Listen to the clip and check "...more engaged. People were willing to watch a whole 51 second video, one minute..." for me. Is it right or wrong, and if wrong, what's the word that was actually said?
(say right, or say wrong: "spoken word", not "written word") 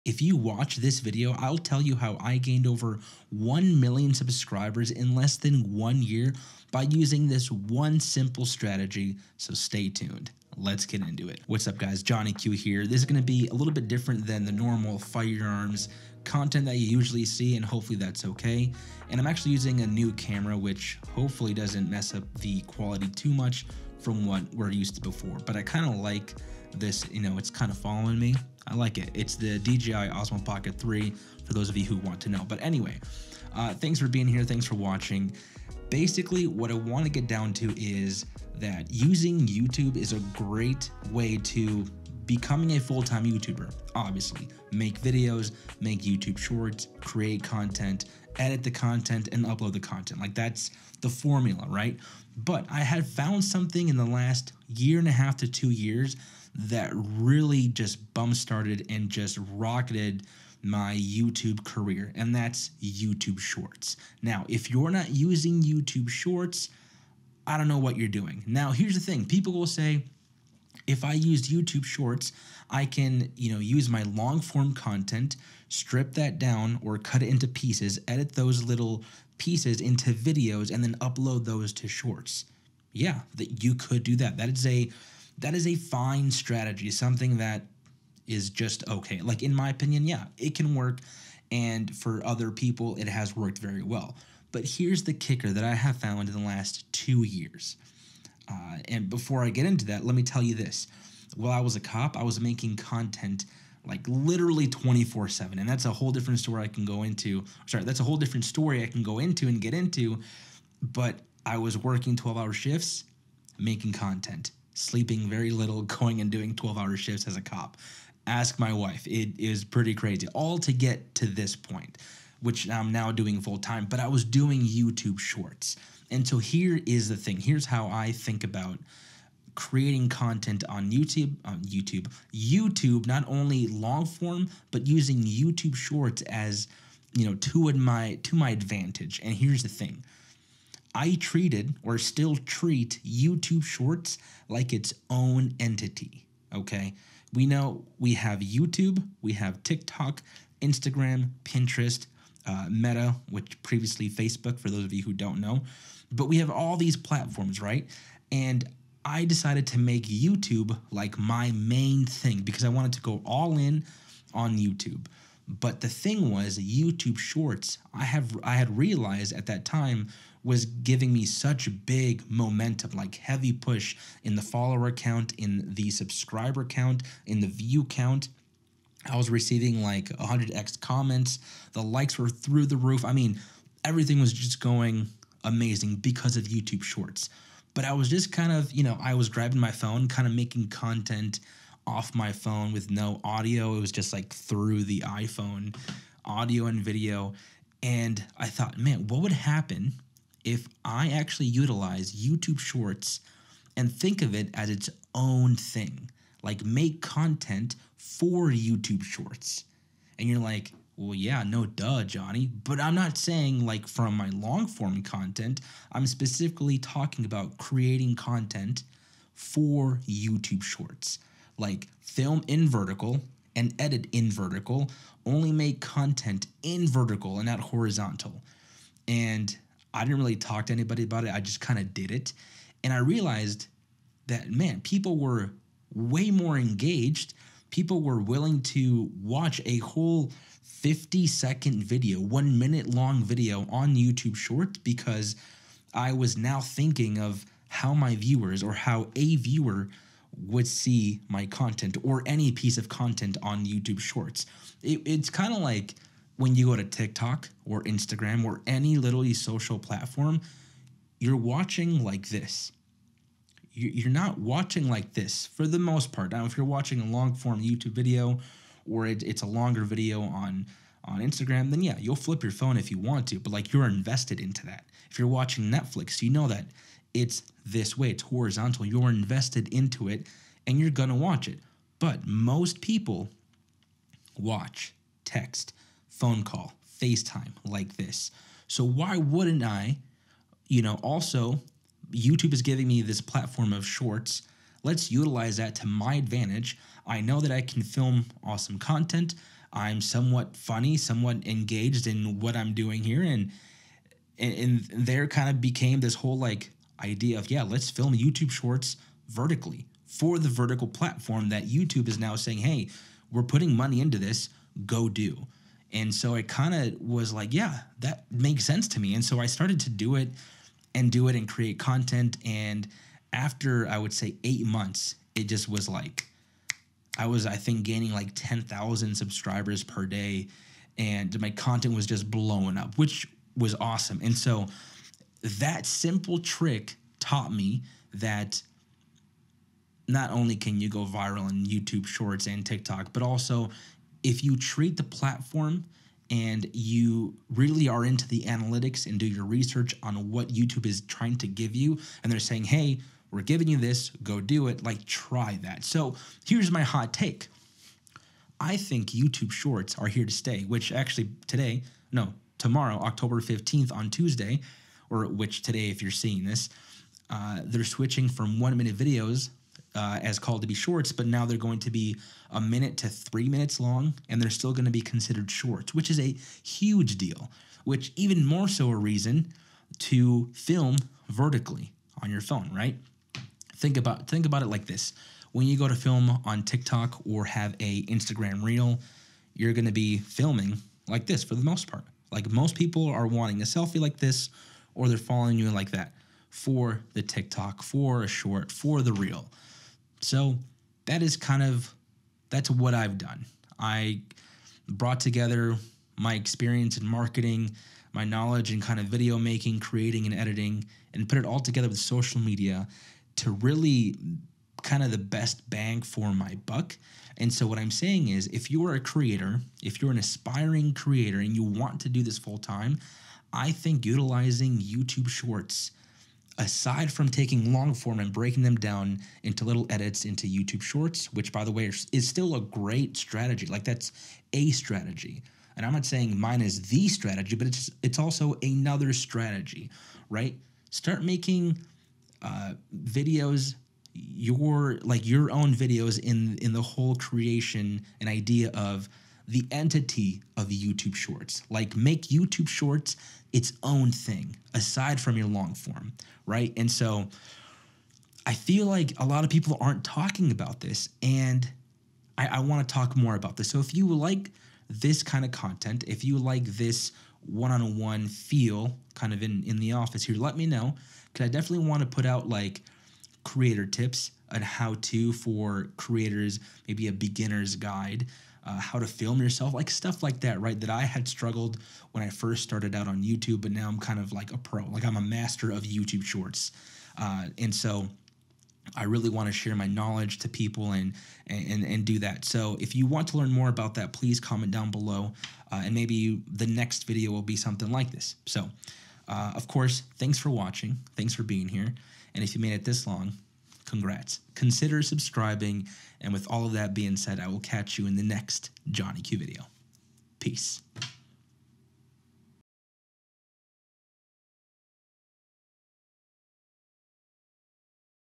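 wrong: "50", not "51".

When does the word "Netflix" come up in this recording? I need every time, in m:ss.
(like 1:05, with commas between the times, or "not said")
4:35.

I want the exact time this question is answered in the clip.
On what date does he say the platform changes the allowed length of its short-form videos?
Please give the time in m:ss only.
6:02.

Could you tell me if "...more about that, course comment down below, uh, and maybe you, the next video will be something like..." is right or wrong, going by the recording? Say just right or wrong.
wrong.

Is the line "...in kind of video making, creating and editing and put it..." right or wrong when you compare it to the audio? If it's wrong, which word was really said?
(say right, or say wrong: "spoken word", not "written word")
right.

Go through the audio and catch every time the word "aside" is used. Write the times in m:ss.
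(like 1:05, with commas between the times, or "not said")
7:06, 7:34.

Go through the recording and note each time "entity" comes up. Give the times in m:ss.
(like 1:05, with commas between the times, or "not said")
2:25, 7:29.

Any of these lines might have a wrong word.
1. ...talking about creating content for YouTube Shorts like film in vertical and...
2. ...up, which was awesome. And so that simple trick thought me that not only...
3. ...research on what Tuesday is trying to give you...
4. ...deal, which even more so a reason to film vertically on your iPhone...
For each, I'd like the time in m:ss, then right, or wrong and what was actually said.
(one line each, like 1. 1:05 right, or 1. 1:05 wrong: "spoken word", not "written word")
1. 3:36 right
2. 5:32 wrong: "taught", not "thought"
3. 5:49 wrong: "YouTube", not "Tuesday"
4. 6:17 wrong: "phone", not "iPhone".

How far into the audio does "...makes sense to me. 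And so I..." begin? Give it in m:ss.
5:18.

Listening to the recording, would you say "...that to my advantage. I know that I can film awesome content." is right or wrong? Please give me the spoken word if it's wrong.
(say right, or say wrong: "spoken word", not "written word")
right.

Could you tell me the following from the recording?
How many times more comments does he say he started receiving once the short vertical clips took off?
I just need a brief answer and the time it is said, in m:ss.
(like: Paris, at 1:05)
100x, at 3:00.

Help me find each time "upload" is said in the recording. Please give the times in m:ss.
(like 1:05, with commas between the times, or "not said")
0:49, 1:20.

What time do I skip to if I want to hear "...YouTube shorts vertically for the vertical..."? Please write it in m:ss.
5:08.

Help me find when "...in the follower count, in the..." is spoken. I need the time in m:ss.
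2:54.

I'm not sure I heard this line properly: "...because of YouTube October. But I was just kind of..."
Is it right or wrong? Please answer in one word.
wrong.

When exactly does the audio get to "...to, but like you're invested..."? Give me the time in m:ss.
4:33.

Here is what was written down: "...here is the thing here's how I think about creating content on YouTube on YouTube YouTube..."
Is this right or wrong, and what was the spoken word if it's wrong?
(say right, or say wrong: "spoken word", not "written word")
right.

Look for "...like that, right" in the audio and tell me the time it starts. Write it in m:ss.
8:00.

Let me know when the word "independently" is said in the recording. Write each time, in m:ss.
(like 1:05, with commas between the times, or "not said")
not said.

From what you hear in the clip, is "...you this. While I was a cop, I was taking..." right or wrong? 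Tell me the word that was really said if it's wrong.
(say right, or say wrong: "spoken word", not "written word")
wrong: "making", not "taking".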